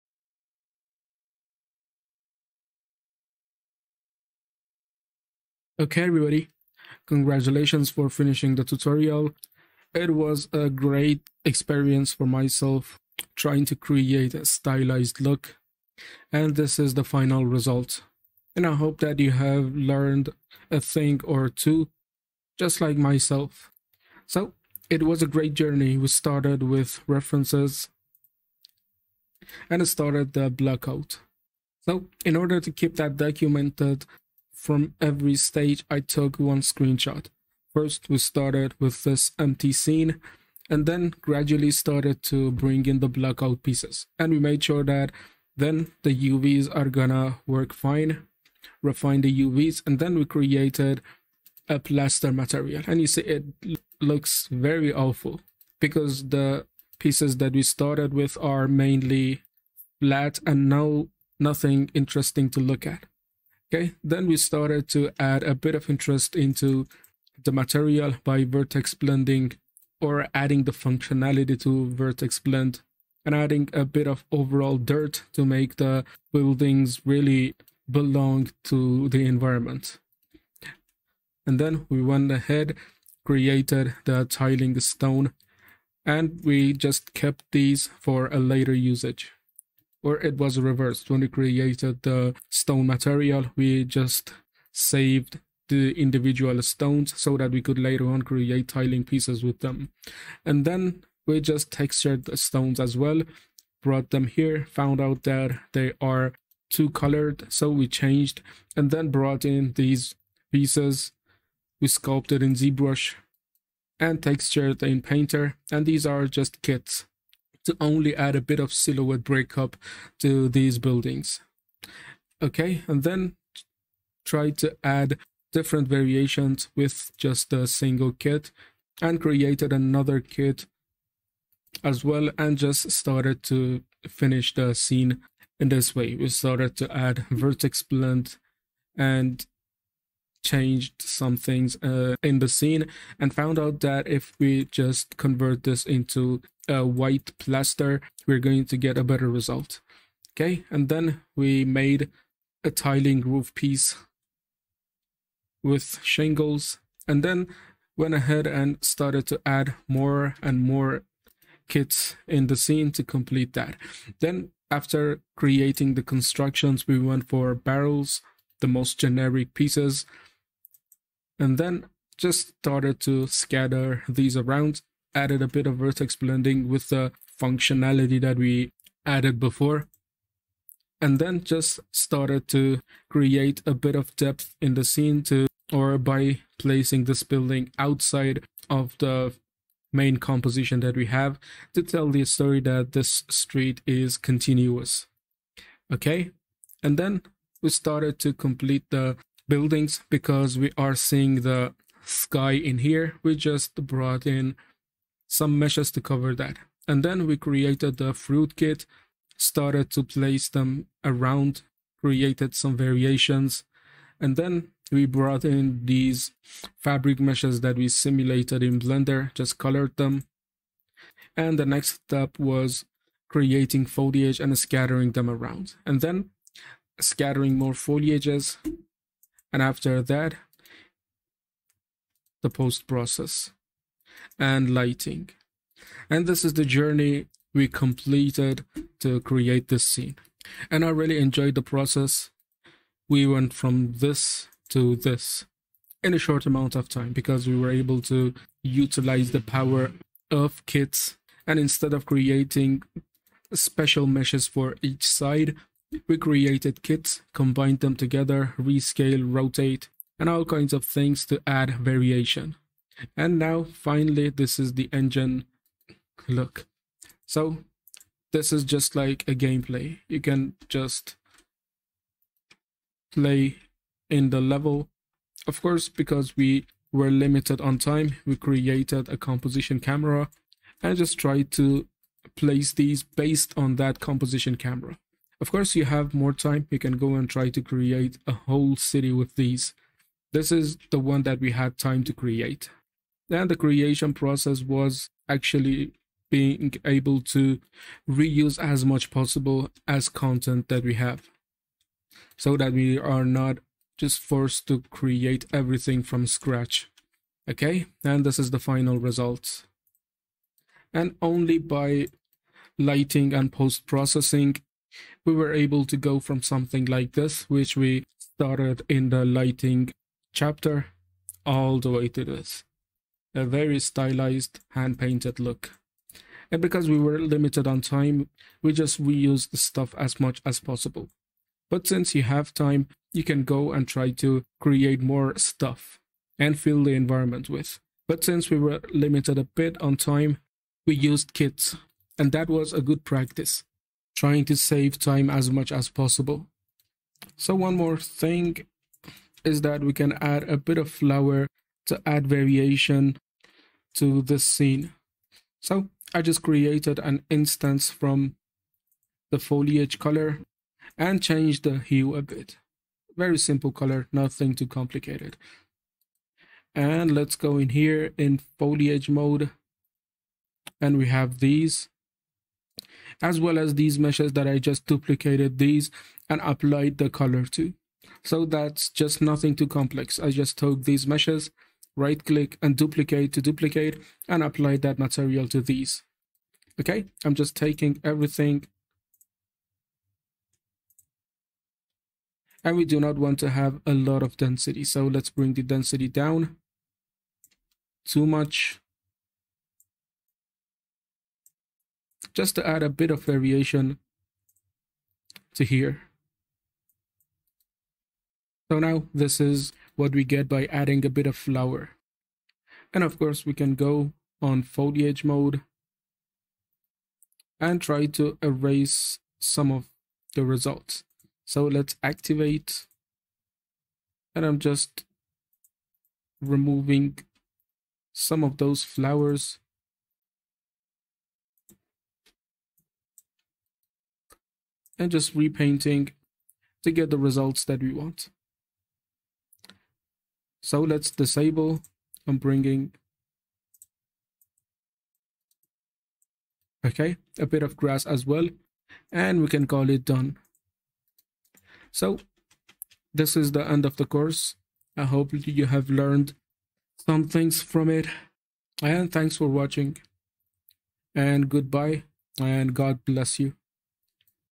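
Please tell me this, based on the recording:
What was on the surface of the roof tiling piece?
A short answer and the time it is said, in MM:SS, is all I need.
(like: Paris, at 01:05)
Shingles, at 02:36.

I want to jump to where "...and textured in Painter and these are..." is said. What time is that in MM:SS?
01:53.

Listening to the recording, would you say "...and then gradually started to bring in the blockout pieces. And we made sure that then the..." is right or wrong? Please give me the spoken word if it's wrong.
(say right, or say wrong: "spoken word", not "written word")
right.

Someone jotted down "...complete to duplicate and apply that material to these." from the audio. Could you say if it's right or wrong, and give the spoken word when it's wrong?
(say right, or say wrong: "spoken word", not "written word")
wrong: "duplicate", not "complete".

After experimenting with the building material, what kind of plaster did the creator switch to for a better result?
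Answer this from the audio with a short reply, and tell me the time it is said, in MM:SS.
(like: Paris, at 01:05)
White plaster, at 02:26.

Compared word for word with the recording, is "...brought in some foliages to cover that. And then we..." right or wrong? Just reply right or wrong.
wrong.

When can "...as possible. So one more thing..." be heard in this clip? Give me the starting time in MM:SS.
05:45.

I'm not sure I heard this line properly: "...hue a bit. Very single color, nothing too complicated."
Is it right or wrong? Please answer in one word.
wrong.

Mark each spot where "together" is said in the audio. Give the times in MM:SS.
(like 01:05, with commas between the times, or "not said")
04:17.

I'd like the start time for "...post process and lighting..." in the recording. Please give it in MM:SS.
03:52.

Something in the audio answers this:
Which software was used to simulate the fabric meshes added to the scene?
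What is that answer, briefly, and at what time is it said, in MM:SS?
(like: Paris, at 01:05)
Blender, at 03:38.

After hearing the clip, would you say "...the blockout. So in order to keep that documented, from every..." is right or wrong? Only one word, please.
right.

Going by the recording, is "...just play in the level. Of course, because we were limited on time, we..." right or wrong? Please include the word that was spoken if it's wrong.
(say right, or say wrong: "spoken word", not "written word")
right.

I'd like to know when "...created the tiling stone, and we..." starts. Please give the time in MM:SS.
01:23.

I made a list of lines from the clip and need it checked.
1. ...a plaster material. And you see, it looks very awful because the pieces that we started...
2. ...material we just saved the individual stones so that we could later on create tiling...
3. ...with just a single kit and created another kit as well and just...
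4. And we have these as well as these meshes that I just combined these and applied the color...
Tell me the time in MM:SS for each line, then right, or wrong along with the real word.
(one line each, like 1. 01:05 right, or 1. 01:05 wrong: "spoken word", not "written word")
1. 00:51 right
2. 01:32 right
3. 02:06 right
4. 06:10 wrong: "duplicated", not "combined".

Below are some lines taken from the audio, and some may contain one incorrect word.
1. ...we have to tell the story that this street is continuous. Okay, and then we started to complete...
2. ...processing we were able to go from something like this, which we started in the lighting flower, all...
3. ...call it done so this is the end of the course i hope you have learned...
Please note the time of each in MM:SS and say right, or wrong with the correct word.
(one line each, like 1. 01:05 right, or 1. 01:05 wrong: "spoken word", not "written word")
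1. 03:10 right
2. 05:13 wrong: "chapter", not "flower"
3. 07:29 right.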